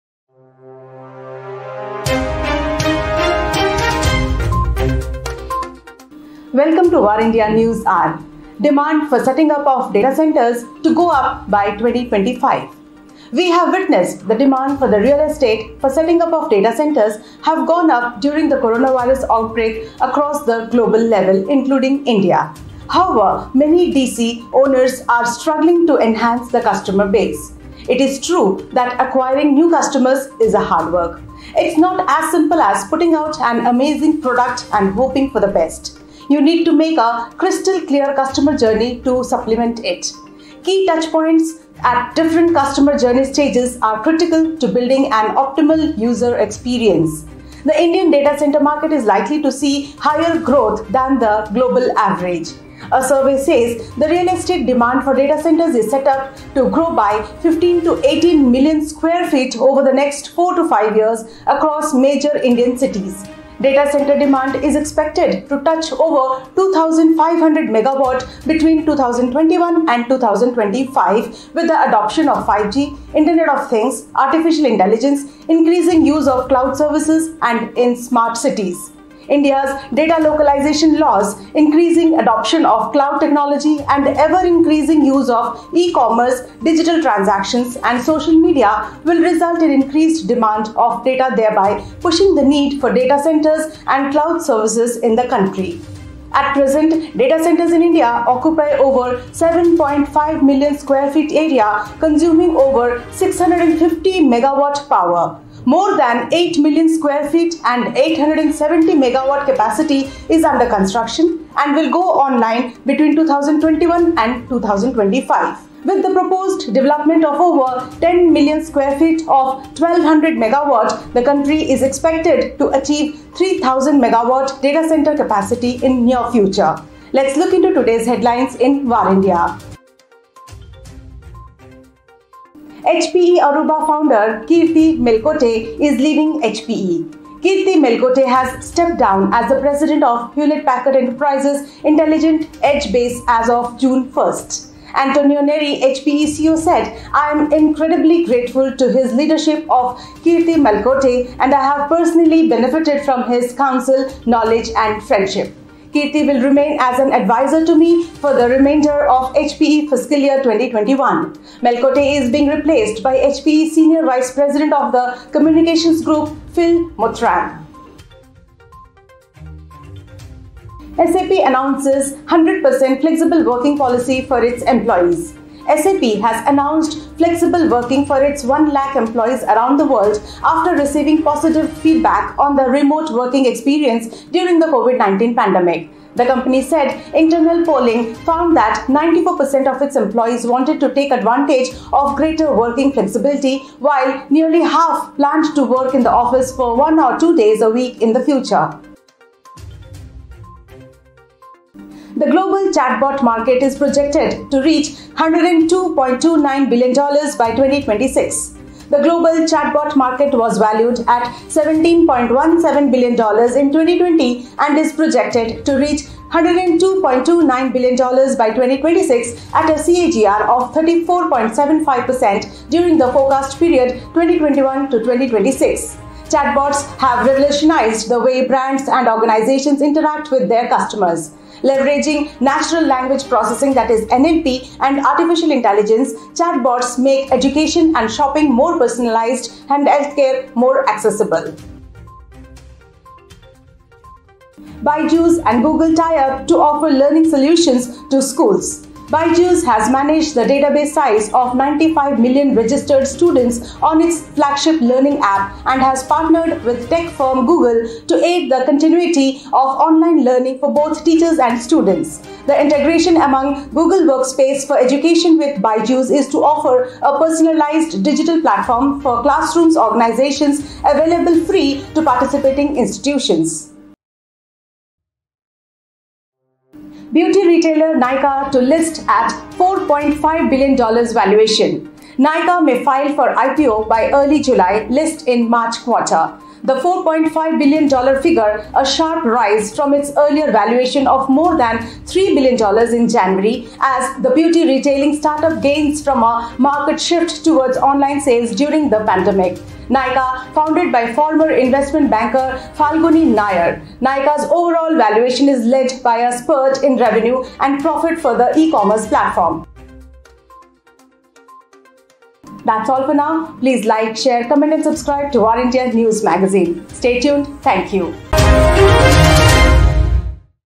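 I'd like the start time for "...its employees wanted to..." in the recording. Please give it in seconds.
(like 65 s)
189 s.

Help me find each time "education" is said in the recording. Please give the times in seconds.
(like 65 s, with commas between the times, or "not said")
237 s, 264 s.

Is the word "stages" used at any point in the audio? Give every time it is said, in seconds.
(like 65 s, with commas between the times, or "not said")
43 s.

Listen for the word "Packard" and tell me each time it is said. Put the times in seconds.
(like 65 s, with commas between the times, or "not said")
140 s.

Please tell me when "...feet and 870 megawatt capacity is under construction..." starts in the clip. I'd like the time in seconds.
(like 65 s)
107 s.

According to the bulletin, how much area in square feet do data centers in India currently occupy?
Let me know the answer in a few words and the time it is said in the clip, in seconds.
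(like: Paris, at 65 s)
7.5 million square feet, at 99 s.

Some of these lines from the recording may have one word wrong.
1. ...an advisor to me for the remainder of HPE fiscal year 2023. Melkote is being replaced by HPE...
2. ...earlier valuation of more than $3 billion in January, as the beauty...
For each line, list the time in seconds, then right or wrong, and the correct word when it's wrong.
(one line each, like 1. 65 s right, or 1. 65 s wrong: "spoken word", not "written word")
1. 156 s wrong: "2021", not "2023"
2. 290 s right.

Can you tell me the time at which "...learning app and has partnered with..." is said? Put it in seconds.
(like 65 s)
254 s.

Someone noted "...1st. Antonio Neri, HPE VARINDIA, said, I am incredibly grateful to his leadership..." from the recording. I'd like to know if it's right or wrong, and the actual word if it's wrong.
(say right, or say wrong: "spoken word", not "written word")
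wrong: "CEO", not "VARINDIA".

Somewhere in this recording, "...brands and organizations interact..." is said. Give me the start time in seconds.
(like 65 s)
228 s.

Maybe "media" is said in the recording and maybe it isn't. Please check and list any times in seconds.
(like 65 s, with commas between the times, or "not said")
88 s.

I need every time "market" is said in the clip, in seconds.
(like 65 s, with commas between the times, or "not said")
48 s, 203 s, 209 s, 296 s.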